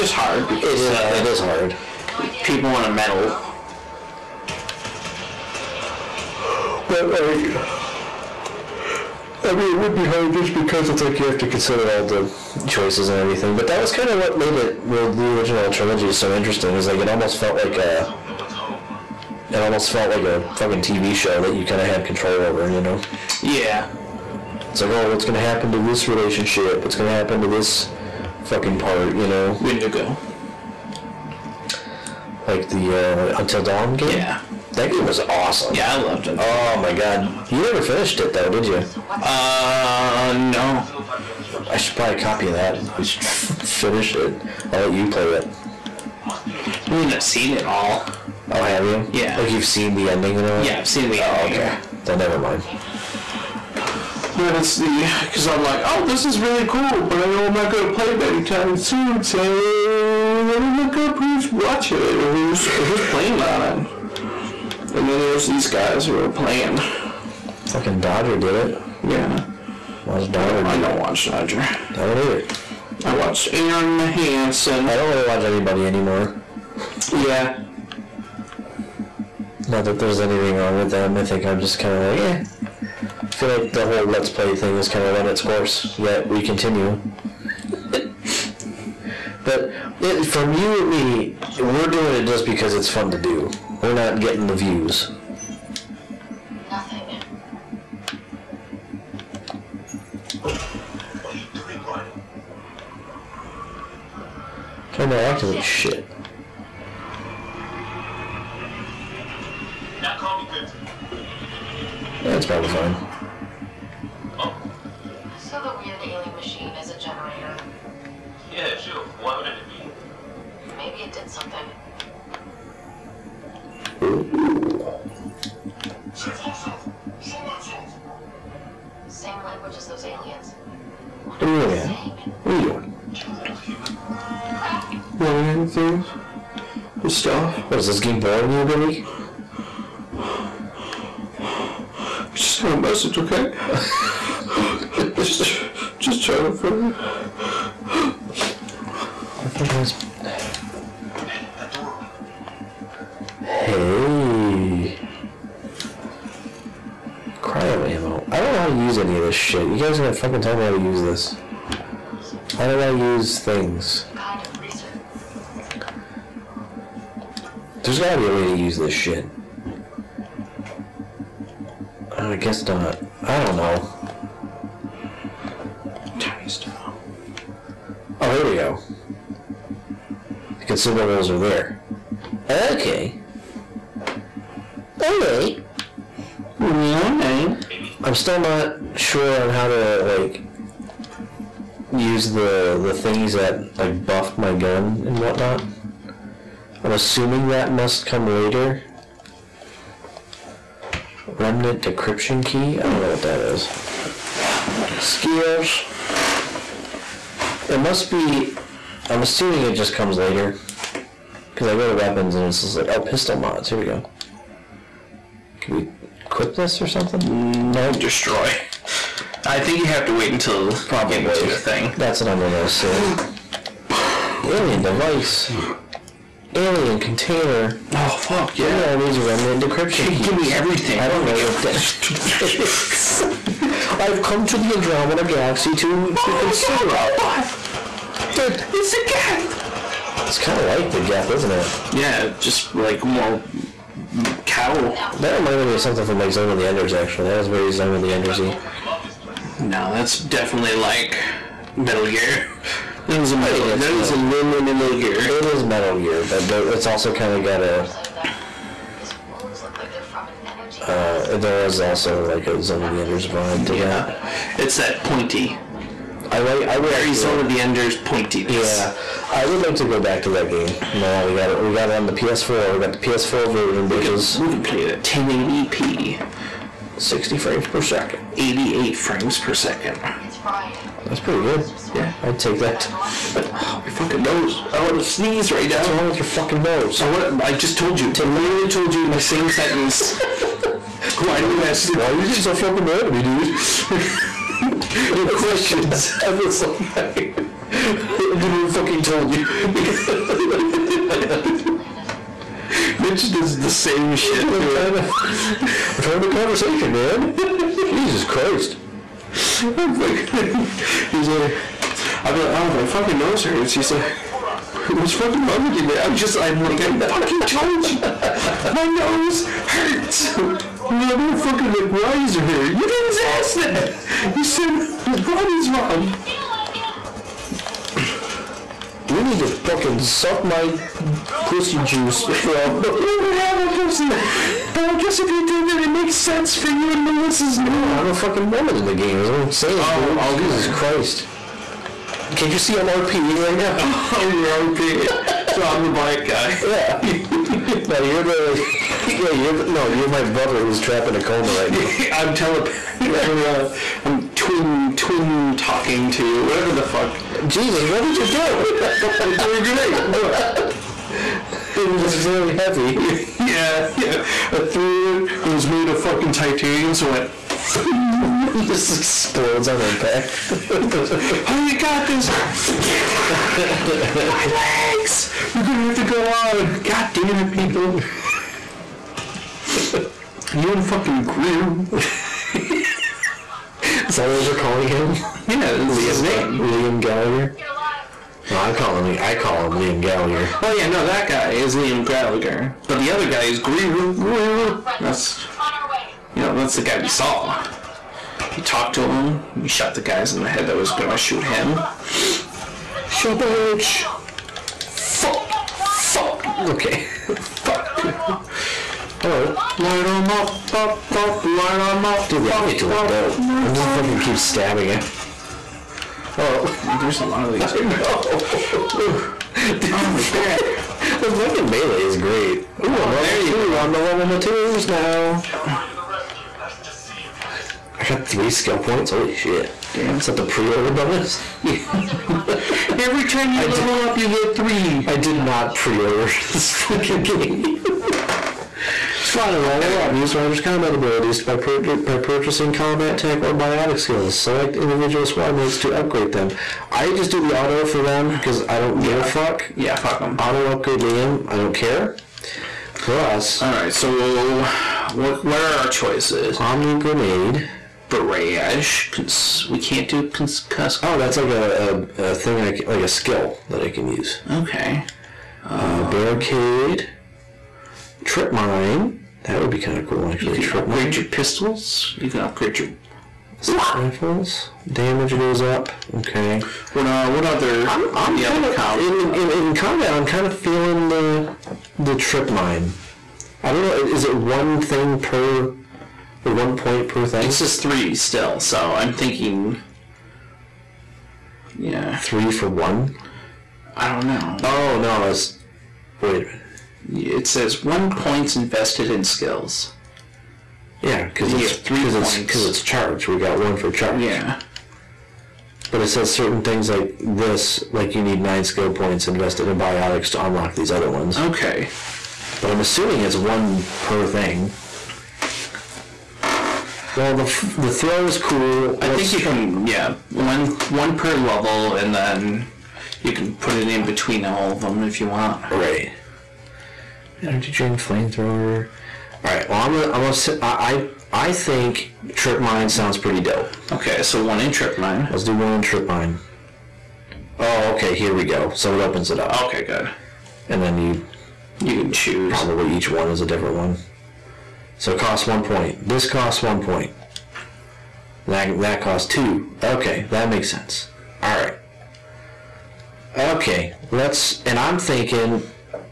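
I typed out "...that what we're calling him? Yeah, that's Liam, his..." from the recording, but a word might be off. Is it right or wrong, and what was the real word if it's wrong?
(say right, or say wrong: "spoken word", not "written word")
right.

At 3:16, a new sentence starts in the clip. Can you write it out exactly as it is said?
I'm assuming that must come later.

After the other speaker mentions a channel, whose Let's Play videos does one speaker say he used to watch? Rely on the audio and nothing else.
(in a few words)
Aaron Mahanson.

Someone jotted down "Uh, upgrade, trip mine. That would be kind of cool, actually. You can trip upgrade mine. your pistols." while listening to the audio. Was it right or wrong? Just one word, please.
wrong.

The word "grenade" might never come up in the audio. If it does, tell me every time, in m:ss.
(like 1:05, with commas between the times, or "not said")
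5:59, 7:36.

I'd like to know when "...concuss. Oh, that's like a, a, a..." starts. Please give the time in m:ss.
7:40.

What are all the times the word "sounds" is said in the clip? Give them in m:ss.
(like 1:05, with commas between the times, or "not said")
8:52.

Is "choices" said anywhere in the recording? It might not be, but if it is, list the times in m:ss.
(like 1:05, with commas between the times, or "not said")
0:12, 7:35.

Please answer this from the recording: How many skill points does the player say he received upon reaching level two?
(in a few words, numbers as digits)
3.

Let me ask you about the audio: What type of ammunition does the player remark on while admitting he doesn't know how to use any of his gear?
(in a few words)
Cryo ammo.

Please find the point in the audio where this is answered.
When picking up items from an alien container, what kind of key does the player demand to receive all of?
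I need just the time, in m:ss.
3:49.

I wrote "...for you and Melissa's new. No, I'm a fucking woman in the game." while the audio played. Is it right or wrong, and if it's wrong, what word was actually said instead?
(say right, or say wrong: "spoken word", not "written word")
right.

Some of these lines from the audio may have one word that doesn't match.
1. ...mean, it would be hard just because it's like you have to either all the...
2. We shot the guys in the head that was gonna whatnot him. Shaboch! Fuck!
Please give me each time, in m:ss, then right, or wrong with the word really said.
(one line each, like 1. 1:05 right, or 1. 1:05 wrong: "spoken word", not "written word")
1. 0:09 wrong: "consider", not "either"
2. 6:39 wrong: "shoot", not "whatnot".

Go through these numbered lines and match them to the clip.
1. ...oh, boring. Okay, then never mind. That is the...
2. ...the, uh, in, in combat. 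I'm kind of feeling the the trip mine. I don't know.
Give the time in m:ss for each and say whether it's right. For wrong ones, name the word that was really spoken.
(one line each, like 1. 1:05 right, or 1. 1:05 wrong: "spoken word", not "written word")
1. 0:51 wrong: "ending", not "boring"
2. 7:59 right.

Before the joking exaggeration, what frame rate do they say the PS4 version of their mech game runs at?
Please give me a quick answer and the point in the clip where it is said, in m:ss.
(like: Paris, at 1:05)
60, at 4:36.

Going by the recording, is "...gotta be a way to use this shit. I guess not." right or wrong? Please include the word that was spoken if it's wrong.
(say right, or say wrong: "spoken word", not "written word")
right.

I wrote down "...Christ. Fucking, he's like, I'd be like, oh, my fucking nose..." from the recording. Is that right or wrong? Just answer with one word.
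right.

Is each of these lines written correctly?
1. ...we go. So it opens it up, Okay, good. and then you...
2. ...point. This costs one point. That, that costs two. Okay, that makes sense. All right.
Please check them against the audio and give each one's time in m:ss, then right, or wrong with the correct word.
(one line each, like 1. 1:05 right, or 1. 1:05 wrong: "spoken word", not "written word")
1. 8:58 right
2. 9:05 right.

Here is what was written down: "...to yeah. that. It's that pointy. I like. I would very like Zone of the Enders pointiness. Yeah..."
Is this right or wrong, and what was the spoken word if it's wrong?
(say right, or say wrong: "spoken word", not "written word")
right.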